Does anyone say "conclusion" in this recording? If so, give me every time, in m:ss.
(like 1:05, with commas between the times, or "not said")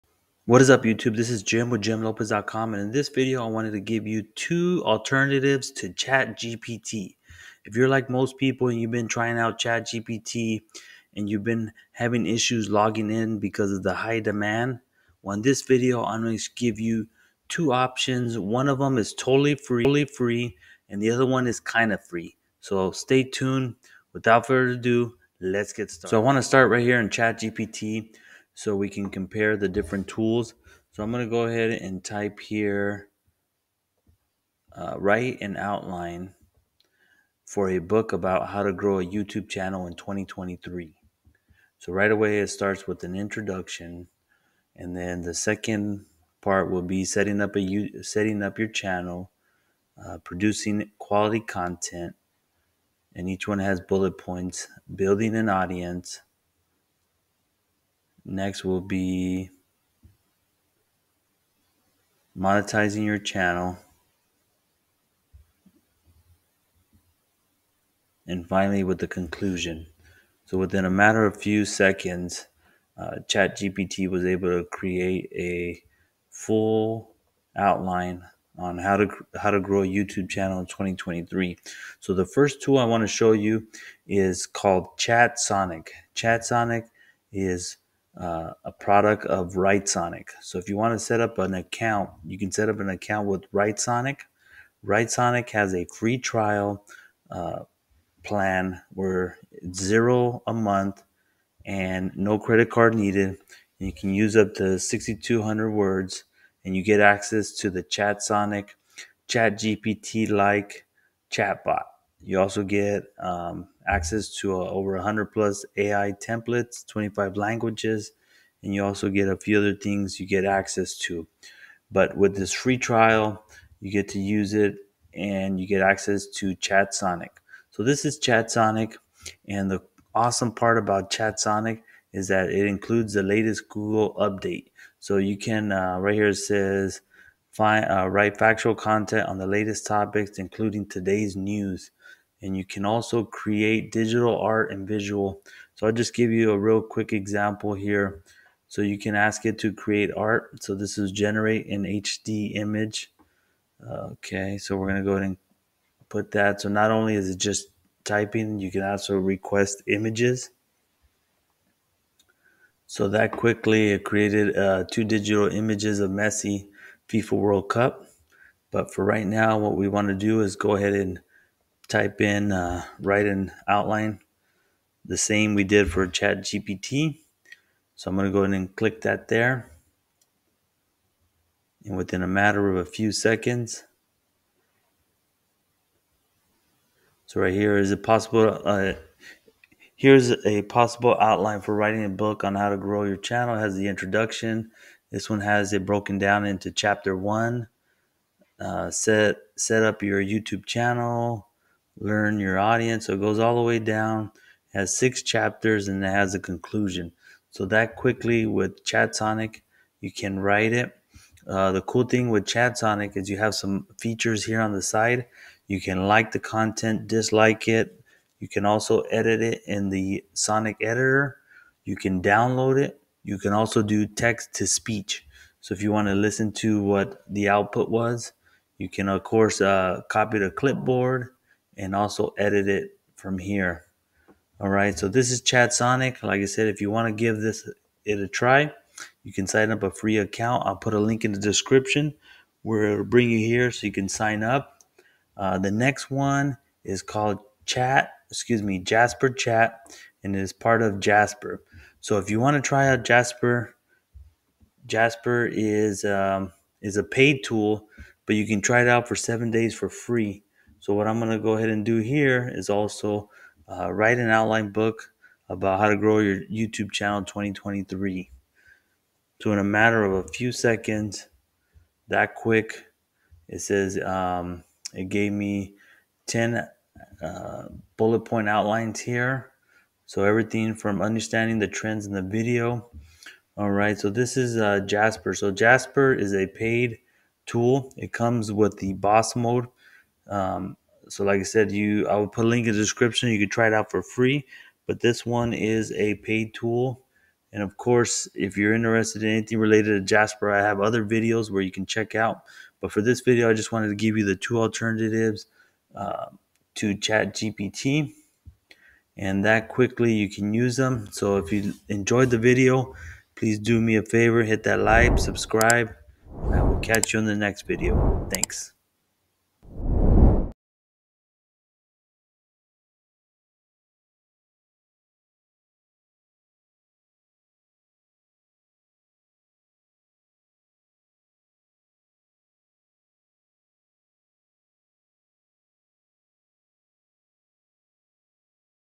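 1:09, 3:26.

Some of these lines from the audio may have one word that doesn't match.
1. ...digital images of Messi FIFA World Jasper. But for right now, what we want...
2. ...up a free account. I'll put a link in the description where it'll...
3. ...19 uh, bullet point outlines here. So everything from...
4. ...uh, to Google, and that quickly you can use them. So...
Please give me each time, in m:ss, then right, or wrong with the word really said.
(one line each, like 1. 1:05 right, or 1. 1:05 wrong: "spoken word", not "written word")
1. 2:45 wrong: "Cup", not "Jasper"
2. 3:59 right
3. 4:36 wrong: "10", not "19"
4. 5:05 wrong: "ChatGPT", not "Google".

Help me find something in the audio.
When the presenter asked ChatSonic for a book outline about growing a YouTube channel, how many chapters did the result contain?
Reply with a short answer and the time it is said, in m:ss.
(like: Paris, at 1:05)
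6, at 3:24.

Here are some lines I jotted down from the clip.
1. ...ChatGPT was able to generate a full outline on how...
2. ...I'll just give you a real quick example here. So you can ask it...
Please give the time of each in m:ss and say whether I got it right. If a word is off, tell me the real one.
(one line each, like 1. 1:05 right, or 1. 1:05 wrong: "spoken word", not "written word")
1. 1:13 wrong: "create", not "generate"
2. 2:25 right.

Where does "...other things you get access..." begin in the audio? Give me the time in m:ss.
1:59.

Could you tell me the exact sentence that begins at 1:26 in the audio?
ChatSonic is uh, a product of Writesonic.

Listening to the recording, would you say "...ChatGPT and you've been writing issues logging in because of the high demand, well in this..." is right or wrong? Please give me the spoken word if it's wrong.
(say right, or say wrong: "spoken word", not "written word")
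wrong: "having", not "writing".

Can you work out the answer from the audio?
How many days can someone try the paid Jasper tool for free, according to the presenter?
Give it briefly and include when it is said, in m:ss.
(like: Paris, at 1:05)
7, at 4:19.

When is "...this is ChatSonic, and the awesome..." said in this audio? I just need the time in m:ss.
2:07.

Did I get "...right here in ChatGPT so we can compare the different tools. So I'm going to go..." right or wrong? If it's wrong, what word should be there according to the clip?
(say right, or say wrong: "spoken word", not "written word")
right.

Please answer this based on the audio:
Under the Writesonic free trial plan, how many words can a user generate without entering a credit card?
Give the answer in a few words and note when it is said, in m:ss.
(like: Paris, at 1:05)
6,200, at 1:44.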